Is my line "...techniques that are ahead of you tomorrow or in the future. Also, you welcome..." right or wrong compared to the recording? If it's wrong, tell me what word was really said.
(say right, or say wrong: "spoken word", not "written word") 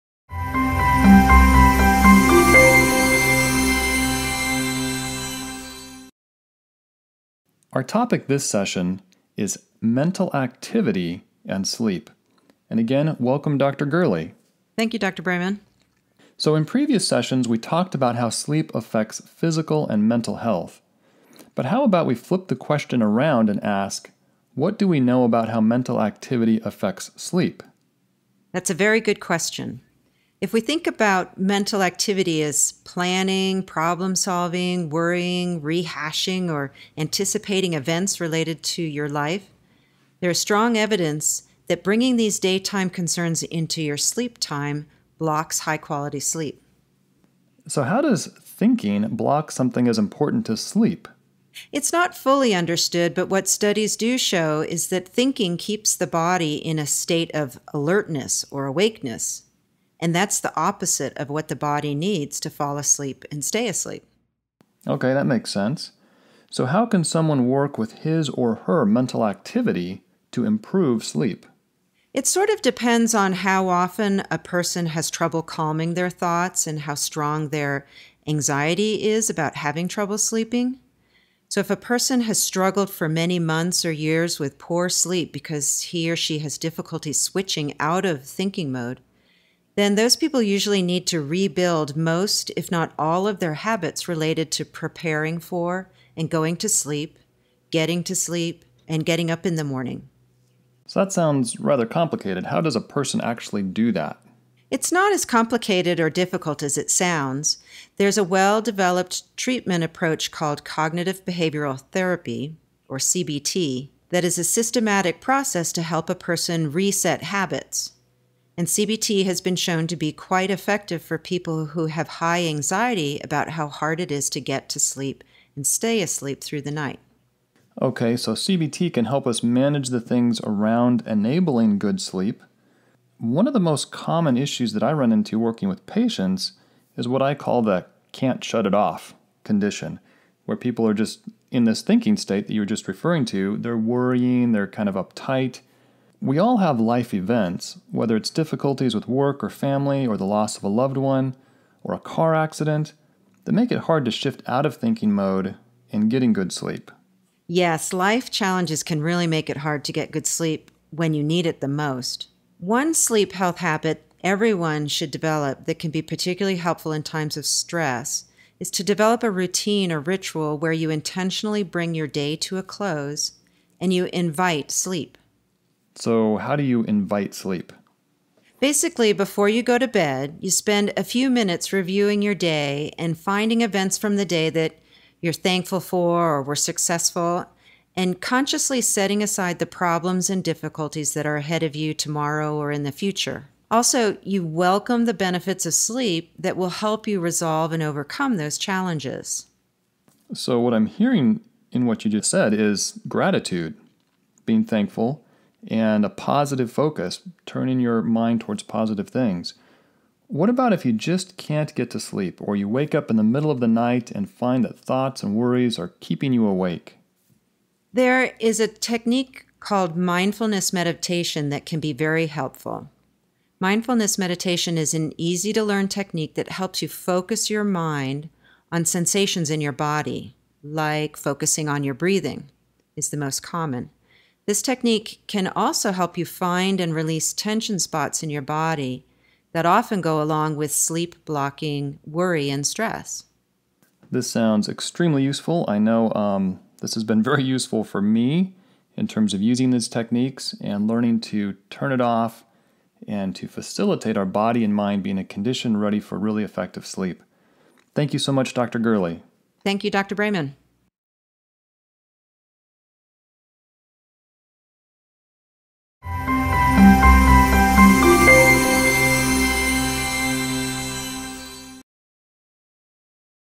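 wrong: "difficulties", not "techniques".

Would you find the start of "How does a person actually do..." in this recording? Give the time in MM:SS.
01:42.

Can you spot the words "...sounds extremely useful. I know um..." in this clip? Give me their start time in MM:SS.
04:04.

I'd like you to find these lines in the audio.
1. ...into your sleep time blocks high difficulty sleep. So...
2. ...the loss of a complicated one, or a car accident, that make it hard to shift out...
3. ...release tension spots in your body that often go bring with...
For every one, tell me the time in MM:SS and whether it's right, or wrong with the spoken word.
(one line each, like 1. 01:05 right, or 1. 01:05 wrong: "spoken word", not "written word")
1. 00:43 wrong: "quality", not "difficulty"
2. 02:30 wrong: "loved", not "complicated"
3. 03:56 wrong: "along", not "bring".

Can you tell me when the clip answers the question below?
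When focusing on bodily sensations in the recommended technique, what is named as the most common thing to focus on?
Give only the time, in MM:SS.
03:51.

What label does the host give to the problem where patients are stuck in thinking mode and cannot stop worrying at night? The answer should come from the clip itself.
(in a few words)
can't shut it off condition.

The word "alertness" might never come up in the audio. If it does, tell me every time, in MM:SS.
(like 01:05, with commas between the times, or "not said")
00:57.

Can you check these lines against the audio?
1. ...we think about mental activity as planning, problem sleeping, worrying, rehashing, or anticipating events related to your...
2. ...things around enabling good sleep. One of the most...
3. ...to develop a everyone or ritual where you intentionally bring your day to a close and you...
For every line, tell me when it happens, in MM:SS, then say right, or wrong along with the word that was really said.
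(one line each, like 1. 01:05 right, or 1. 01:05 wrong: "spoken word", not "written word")
1. 00:30 wrong: "solving", not "sleeping"
2. 02:09 right
3. 02:48 wrong: "routine", not "everyone".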